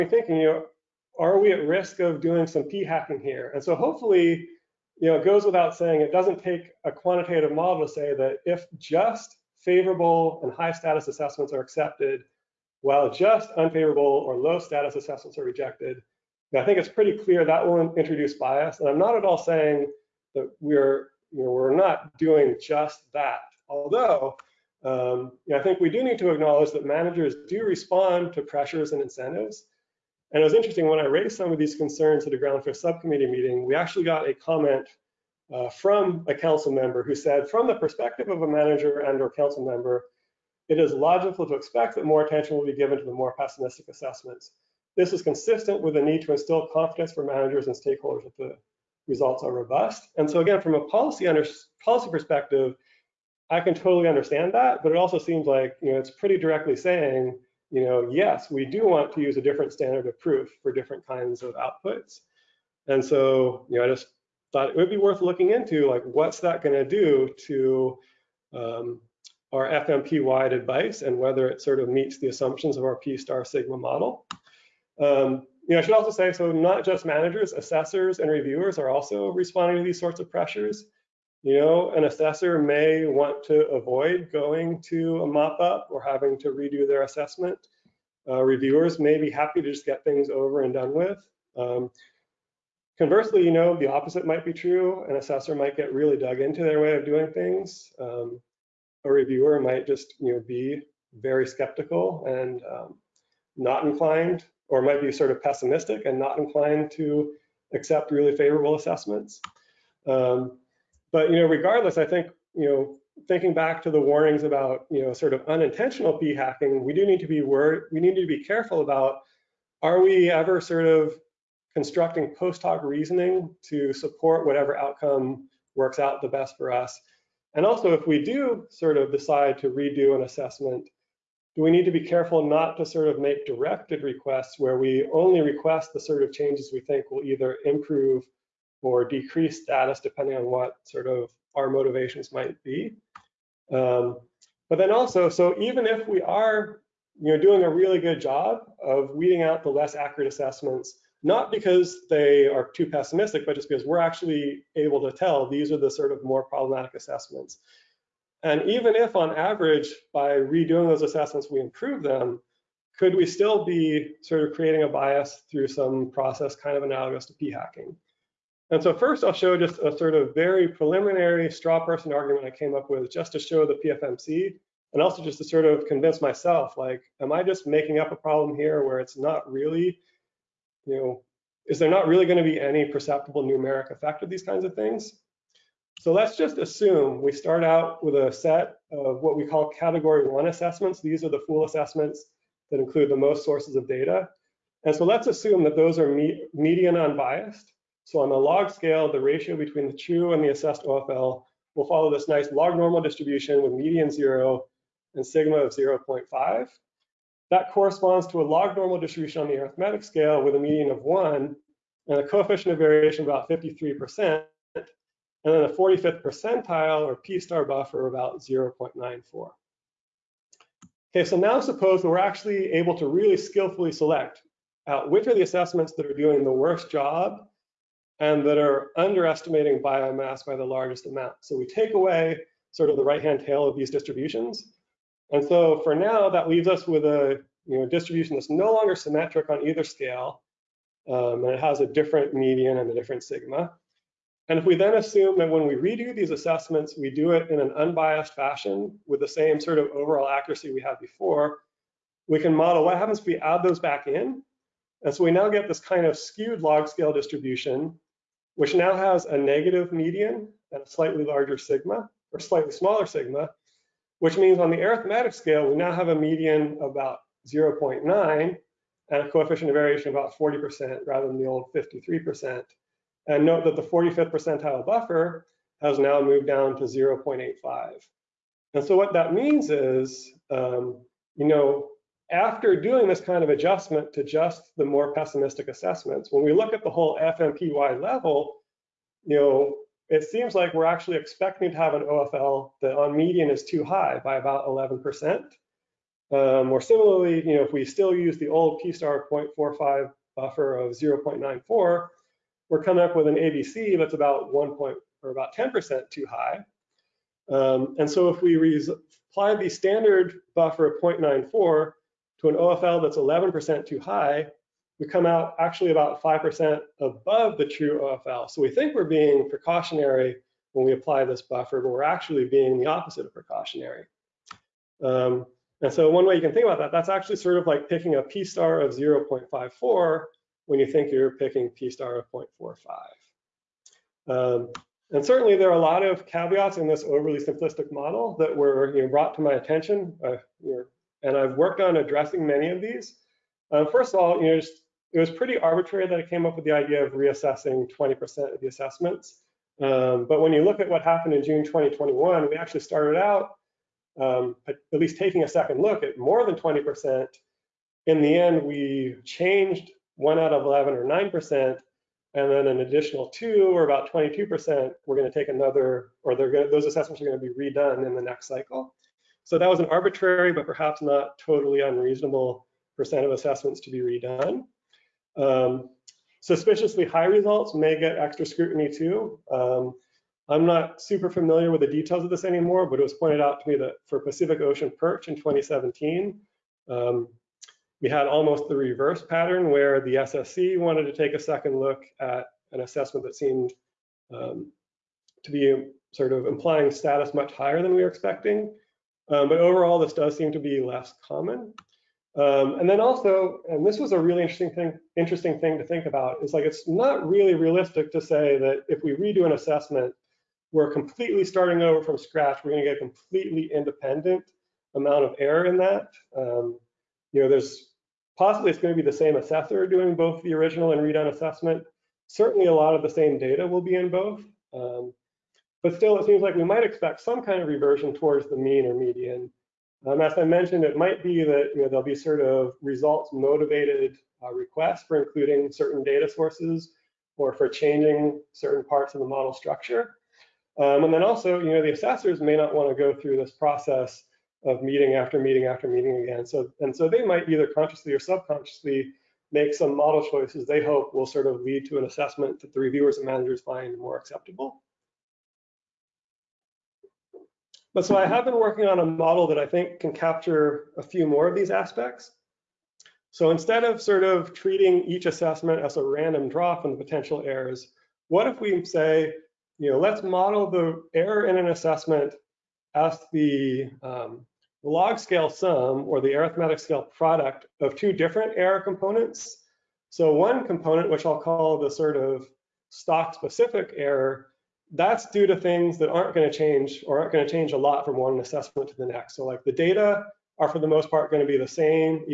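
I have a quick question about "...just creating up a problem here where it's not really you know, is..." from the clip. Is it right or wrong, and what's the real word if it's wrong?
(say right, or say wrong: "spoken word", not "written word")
wrong: "making", not "creating".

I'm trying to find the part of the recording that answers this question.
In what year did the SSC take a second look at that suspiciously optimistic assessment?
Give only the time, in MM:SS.
06:25.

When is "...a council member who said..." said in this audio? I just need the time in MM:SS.
00:36.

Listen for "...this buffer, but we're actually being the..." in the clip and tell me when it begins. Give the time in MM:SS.
05:21.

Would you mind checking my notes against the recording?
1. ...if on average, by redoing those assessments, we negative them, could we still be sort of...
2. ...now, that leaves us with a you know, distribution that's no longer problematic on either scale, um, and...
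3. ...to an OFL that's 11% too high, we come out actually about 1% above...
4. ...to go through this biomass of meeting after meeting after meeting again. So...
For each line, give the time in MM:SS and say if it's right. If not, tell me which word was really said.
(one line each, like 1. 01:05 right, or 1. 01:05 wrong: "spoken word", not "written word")
1. 02:38 wrong: "improve", not "negative"
2. 03:55 wrong: "symmetric", not "problematic"
3. 05:12 wrong: "5", not "1"
4. 07:22 wrong: "process", not "biomass".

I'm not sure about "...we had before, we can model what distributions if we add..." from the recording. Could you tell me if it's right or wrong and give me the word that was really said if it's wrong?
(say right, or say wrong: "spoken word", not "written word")
wrong: "happens", not "distributions".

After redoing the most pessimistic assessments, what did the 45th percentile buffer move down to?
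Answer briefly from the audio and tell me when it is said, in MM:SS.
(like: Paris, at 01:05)
0.85, at 04:36.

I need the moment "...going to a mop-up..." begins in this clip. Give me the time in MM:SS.
01:24.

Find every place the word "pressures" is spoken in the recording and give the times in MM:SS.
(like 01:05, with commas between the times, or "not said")
00:28, 01:20.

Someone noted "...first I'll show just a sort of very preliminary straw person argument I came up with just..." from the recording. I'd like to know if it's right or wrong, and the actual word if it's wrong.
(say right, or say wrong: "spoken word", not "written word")
right.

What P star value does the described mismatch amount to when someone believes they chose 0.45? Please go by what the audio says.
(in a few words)
0.54.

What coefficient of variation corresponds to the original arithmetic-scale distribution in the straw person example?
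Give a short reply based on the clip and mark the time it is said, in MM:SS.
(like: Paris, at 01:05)
about 53%, at 03:33.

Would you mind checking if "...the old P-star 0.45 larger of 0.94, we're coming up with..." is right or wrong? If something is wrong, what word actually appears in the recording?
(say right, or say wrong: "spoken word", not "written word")
wrong: "buffer", not "larger".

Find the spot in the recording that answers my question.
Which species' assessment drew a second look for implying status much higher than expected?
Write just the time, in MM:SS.
06:24.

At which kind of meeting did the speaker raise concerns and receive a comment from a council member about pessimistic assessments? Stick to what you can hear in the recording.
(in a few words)
groundfish subcommittee meeting.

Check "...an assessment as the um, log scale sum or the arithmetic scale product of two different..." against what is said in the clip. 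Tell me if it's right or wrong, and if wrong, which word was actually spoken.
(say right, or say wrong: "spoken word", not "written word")
right.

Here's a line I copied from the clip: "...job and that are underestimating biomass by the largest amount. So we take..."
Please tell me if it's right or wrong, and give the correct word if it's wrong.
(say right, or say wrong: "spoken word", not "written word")
right.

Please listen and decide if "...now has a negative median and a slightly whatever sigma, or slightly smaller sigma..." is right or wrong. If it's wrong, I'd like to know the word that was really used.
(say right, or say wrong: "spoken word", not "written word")
wrong: "larger", not "whatever".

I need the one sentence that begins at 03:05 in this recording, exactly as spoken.
So let's just assume we start out with a set of what we call category one assessments.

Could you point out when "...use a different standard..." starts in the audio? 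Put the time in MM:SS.
00:59.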